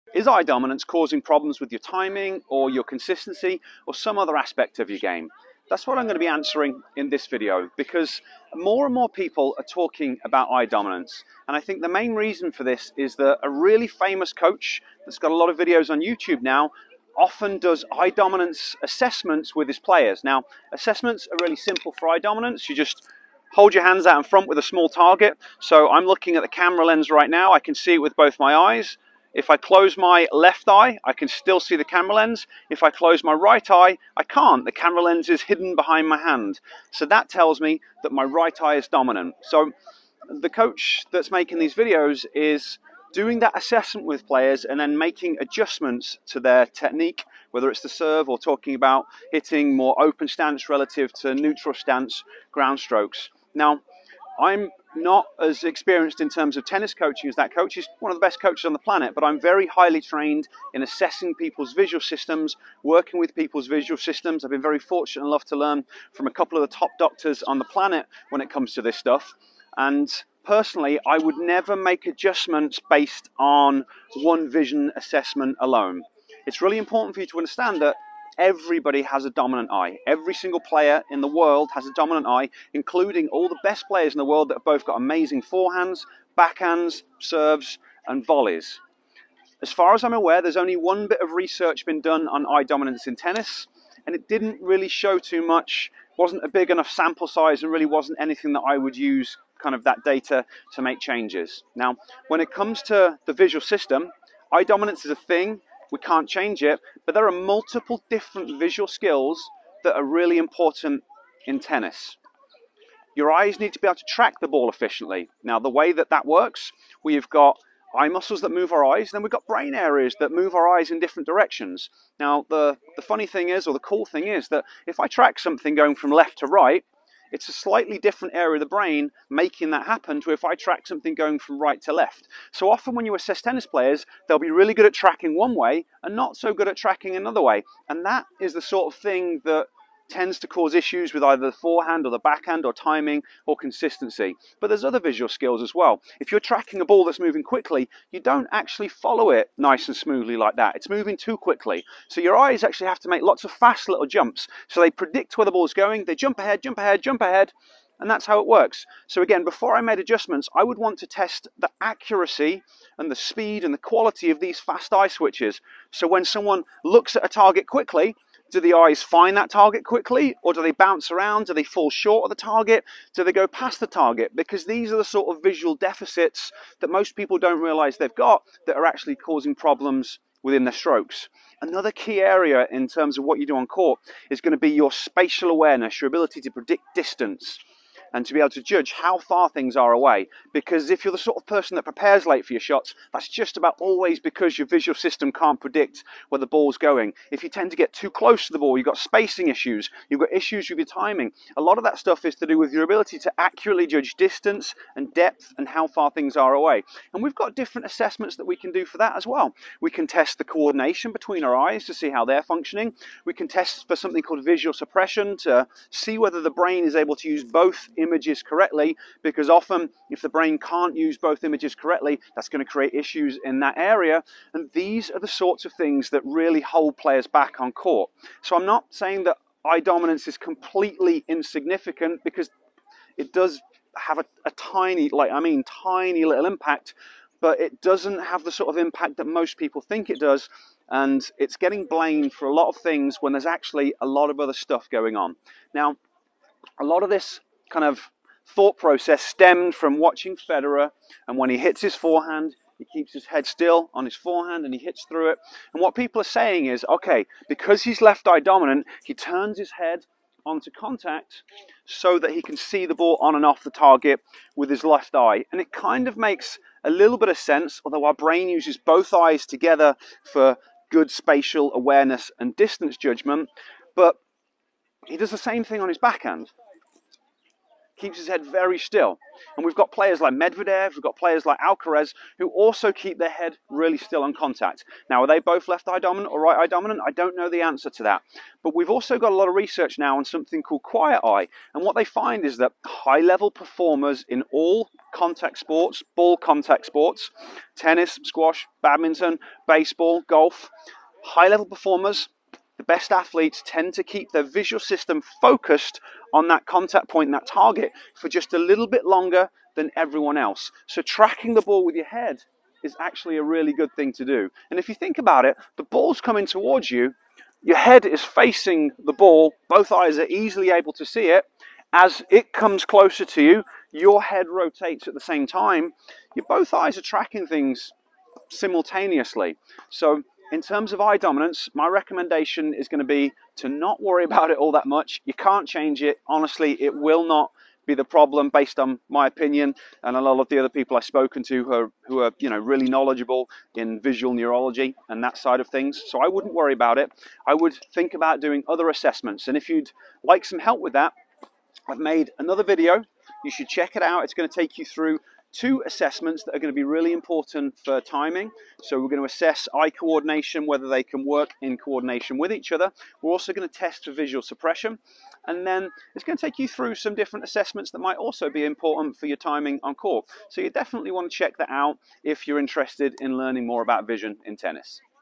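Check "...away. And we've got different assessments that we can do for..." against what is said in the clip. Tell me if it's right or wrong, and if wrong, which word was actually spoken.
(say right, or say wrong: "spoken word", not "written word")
right.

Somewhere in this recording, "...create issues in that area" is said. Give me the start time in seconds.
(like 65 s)
222 s.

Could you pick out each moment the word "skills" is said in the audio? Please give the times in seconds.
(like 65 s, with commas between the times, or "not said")
108 s, 145 s.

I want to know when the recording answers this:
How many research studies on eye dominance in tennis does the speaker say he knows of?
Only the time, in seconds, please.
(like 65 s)
90 s.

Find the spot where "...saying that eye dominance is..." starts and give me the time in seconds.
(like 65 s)
228 s.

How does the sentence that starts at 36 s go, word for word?
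So that tells me that my right eye is dominant.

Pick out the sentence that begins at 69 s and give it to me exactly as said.
And personally, I would never make adjustments based on one vision assessment alone.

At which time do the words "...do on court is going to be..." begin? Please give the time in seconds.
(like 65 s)
183 s.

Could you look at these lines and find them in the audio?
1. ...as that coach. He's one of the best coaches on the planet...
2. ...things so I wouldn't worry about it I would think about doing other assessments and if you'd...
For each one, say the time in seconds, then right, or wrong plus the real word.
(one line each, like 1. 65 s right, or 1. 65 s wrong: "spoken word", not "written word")
1. 57 s right
2. 345 s right.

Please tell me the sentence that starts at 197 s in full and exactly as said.
If you tend to get too close to the ball, you've got spacing issues, you've got issues with your timing.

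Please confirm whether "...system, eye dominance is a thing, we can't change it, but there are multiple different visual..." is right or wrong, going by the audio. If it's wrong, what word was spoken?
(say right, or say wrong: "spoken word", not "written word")
right.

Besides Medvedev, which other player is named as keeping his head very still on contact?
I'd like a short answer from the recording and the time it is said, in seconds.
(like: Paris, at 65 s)
Alcaraz, at 281 s.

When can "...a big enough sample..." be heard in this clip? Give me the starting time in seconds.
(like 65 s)
96 s.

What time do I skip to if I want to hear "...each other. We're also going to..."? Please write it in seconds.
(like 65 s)
362 s.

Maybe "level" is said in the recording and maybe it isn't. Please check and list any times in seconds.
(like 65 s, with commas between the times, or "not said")
293 s, 301 s.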